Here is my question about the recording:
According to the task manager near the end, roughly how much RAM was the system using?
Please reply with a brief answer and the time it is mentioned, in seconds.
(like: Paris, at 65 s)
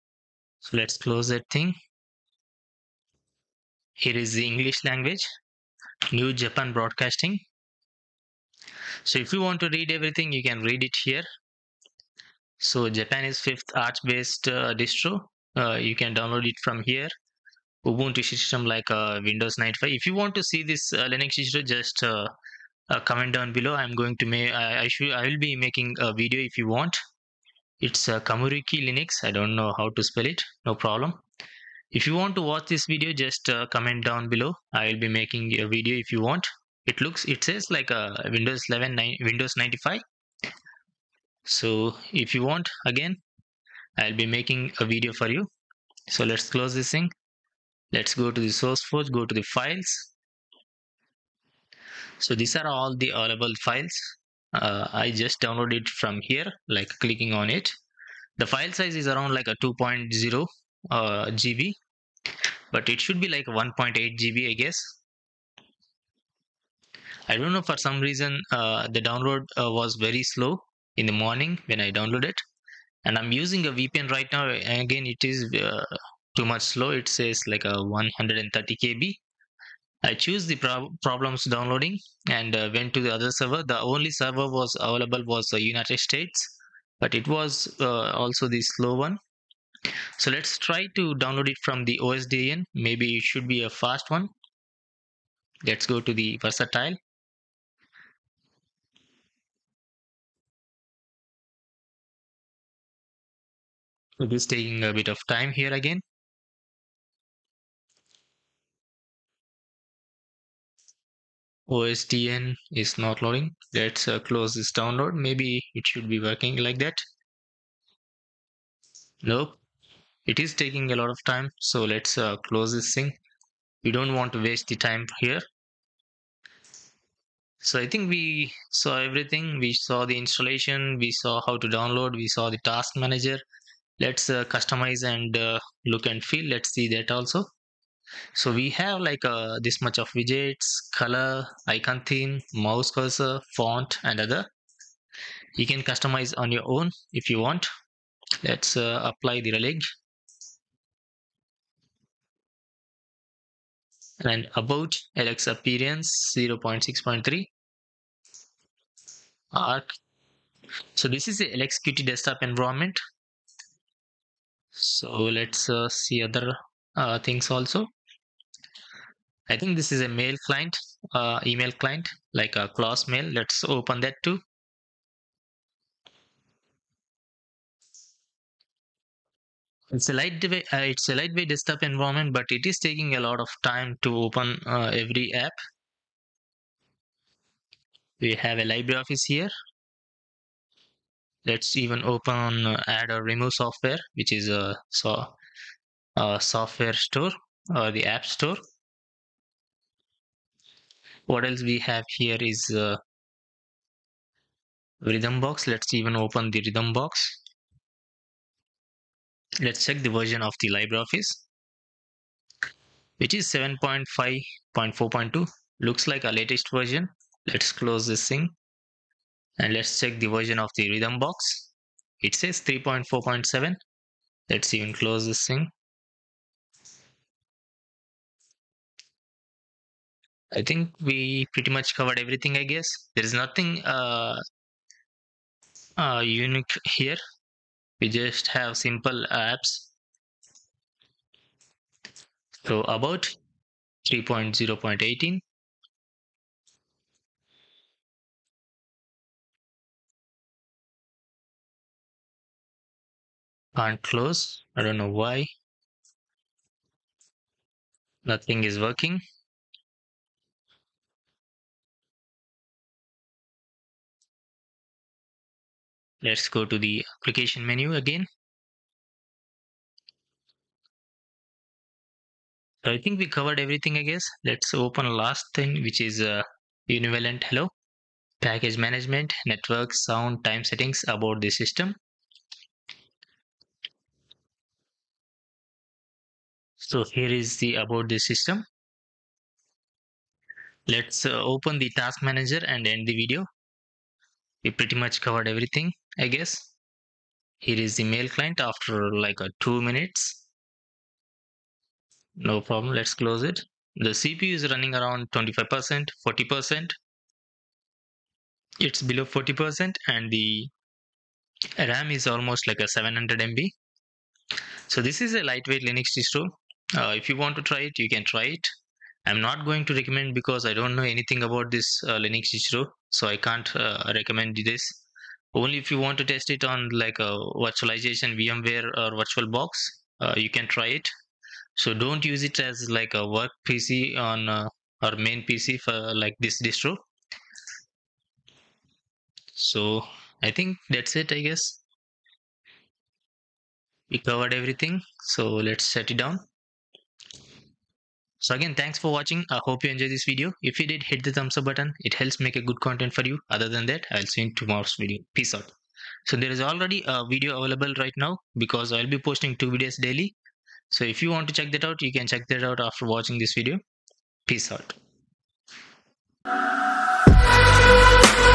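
700 MB, at 312 s.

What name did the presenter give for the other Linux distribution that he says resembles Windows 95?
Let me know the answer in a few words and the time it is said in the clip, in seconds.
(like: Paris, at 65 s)
Kamuriki Linux, at 28 s.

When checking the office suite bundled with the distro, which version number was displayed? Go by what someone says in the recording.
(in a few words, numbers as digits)
7.5.4.2.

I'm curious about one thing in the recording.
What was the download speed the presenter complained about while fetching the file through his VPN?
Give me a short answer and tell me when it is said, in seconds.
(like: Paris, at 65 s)
130 KB, at 77 s.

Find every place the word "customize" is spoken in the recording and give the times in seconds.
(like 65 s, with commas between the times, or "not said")
134 s, 145 s.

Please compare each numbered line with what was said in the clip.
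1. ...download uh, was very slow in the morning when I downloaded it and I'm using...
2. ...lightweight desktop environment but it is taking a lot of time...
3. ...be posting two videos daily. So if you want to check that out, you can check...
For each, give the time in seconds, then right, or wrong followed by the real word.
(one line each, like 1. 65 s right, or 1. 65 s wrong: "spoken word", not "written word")
1. 69 s right
2. 181 s right
3. 359 s right.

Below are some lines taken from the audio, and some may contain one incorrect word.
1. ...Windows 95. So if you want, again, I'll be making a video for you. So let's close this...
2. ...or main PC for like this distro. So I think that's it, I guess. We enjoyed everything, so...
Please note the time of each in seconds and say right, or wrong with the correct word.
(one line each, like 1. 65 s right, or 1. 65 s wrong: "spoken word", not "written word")
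1. 39 s right
2. 335 s wrong: "covered", not "enjoyed".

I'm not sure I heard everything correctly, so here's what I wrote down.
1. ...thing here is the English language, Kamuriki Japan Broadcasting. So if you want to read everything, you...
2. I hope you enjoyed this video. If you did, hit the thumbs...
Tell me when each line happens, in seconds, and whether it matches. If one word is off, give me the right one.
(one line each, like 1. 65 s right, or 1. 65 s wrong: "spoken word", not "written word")
1. 1 s wrong: "New", not "Kamuriki"
2. 349 s right.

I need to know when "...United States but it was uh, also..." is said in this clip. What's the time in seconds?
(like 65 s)
85 s.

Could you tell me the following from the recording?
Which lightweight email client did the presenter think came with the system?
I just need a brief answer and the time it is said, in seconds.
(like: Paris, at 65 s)
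Claws Mail, at 172 s.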